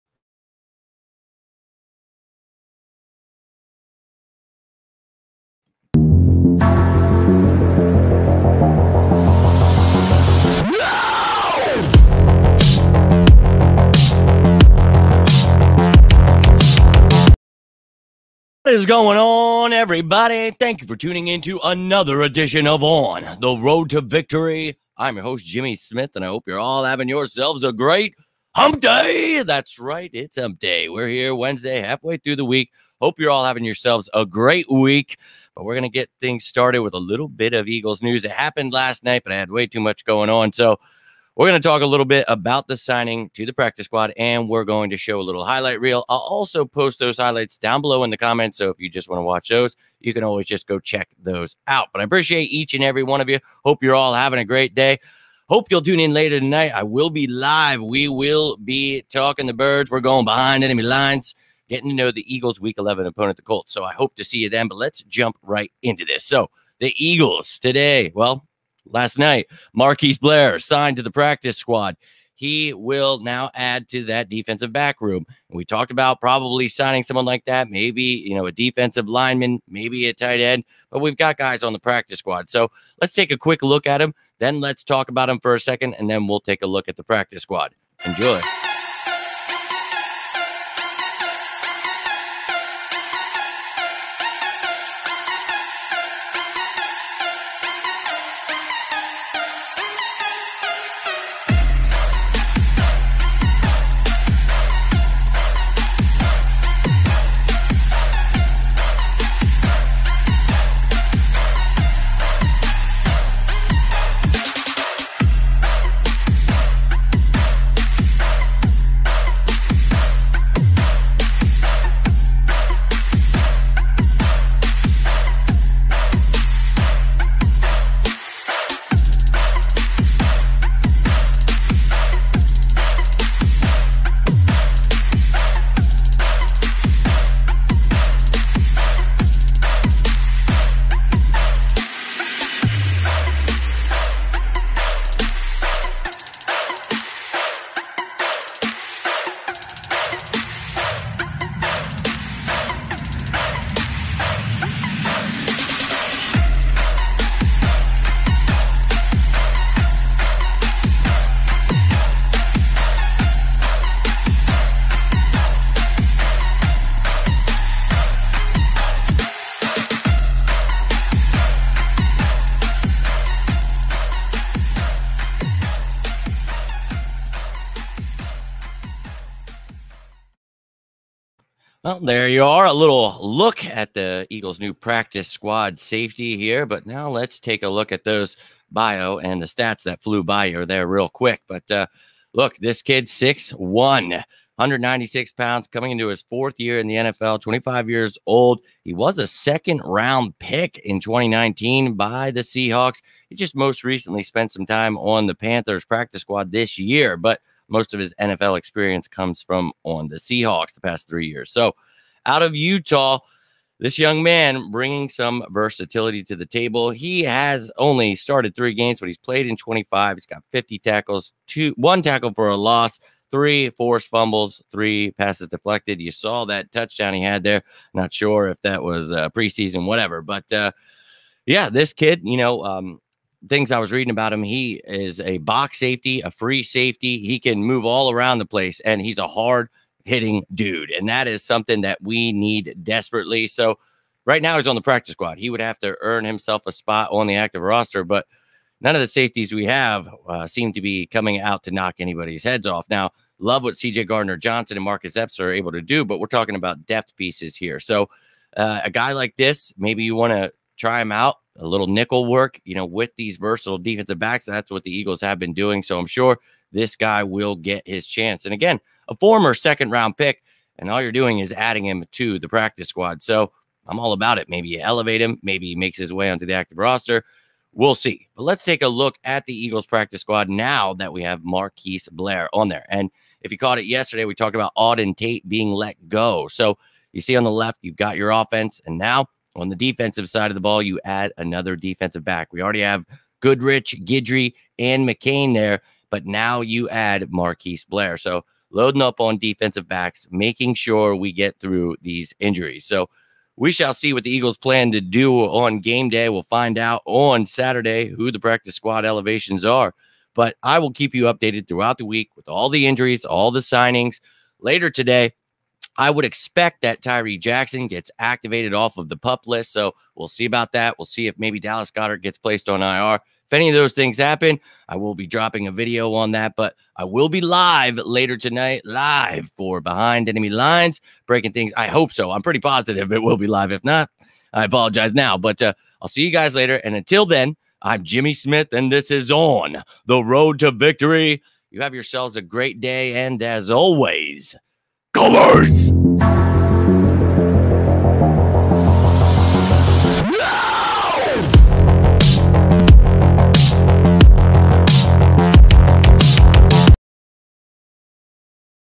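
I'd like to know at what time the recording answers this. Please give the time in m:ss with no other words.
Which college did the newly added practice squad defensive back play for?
3:32.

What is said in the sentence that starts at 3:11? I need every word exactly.
But uh, look, this kid, 6'1, 196 pounds, coming into his fourth year in the NFL, 25 years old.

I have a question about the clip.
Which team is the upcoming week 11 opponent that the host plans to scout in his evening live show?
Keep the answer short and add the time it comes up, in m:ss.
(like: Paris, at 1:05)
Colts, at 1:03.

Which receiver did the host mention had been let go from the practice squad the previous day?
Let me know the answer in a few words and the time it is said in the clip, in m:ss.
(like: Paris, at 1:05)
Auden Tate, at 4:44.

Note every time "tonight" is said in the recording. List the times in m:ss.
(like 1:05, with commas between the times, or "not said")
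0:56, 5:28.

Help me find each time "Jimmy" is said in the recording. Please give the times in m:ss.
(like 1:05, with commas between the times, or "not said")
0:25, 5:38.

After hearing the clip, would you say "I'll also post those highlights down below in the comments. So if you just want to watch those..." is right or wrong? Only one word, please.
right.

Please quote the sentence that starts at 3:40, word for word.
He's got 50 tackles, two, one tackle for a loss, three forced fumbles, three passes deflected.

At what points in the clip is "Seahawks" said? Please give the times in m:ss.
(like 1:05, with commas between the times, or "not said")
3:22, 3:30.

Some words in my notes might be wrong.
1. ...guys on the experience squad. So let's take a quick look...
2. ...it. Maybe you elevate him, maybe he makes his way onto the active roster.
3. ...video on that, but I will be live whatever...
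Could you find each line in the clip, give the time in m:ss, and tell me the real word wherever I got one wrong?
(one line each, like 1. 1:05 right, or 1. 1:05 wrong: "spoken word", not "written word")
1. 1:21 wrong: "practice", not "experience"
2. 4:34 right
3. 5:25 wrong: "later", not "whatever".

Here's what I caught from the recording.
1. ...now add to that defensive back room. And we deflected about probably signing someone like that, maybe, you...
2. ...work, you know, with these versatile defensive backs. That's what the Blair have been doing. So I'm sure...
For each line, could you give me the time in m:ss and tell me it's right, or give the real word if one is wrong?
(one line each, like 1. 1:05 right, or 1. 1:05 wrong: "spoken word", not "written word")
1. 1:13 wrong: "talked", not "deflected"
2. 4:22 wrong: "Eagles", not "Blair".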